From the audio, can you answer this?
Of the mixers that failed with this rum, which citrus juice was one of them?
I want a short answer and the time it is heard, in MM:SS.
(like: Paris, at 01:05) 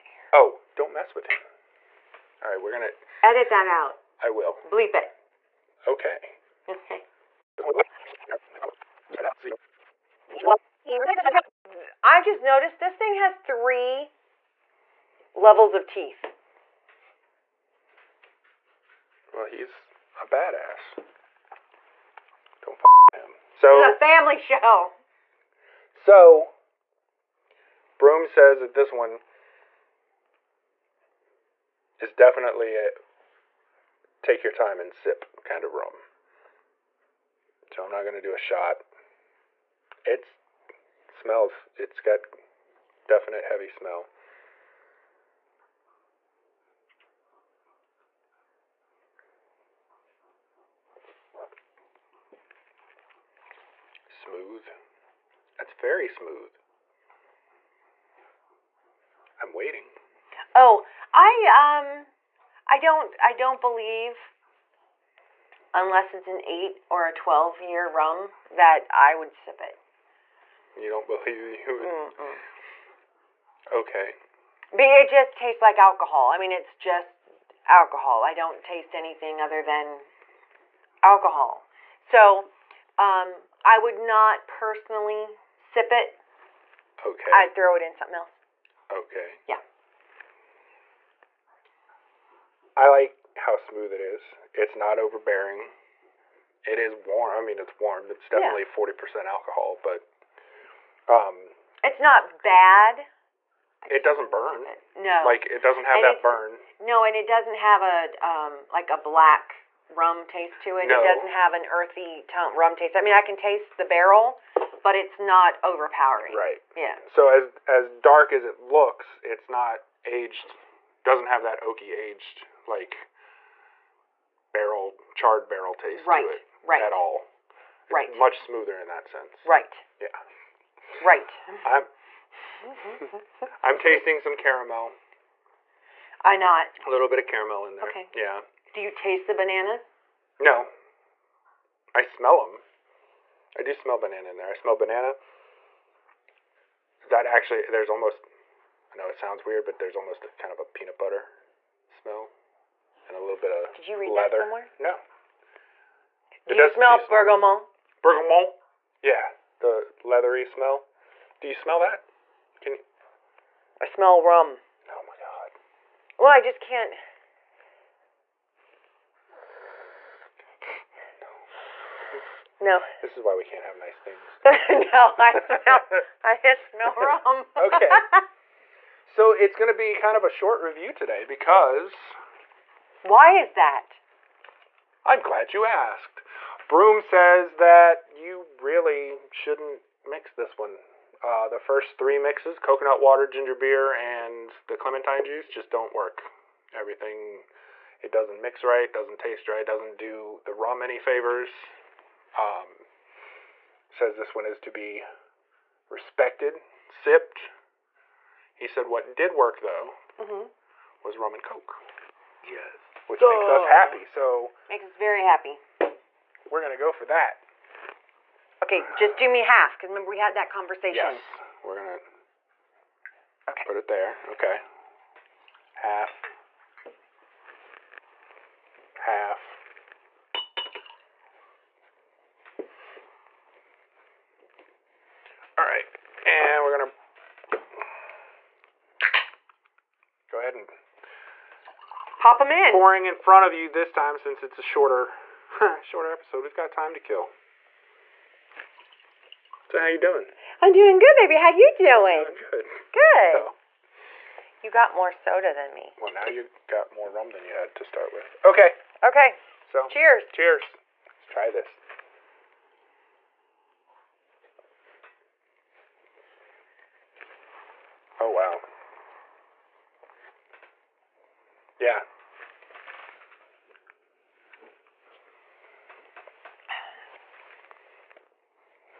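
clementine juice, at 03:14.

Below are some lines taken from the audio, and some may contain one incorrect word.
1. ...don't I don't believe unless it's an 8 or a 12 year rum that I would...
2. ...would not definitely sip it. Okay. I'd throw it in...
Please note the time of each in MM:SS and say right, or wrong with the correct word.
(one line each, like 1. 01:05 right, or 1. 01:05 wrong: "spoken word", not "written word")
1. 01:02 right
2. 01:23 wrong: "personally", not "definitely".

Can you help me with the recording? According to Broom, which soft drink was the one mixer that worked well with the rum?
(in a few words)
Coke.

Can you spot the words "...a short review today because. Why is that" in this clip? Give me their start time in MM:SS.
03:00.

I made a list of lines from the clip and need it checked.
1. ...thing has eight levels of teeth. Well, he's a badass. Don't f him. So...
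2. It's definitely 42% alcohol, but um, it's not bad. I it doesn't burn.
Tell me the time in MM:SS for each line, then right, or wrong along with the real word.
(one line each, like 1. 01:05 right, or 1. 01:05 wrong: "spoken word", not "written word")
1. 00:12 wrong: "three", not "eight"
2. 01:38 wrong: "40", not "42".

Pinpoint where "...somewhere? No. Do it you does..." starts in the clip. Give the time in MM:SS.
02:34.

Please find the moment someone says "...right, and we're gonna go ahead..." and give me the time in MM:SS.
03:55.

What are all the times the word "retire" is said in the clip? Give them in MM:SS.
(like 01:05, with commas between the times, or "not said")
not said.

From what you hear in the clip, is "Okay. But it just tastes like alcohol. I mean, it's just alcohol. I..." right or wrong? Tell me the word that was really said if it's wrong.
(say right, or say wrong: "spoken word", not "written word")
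right.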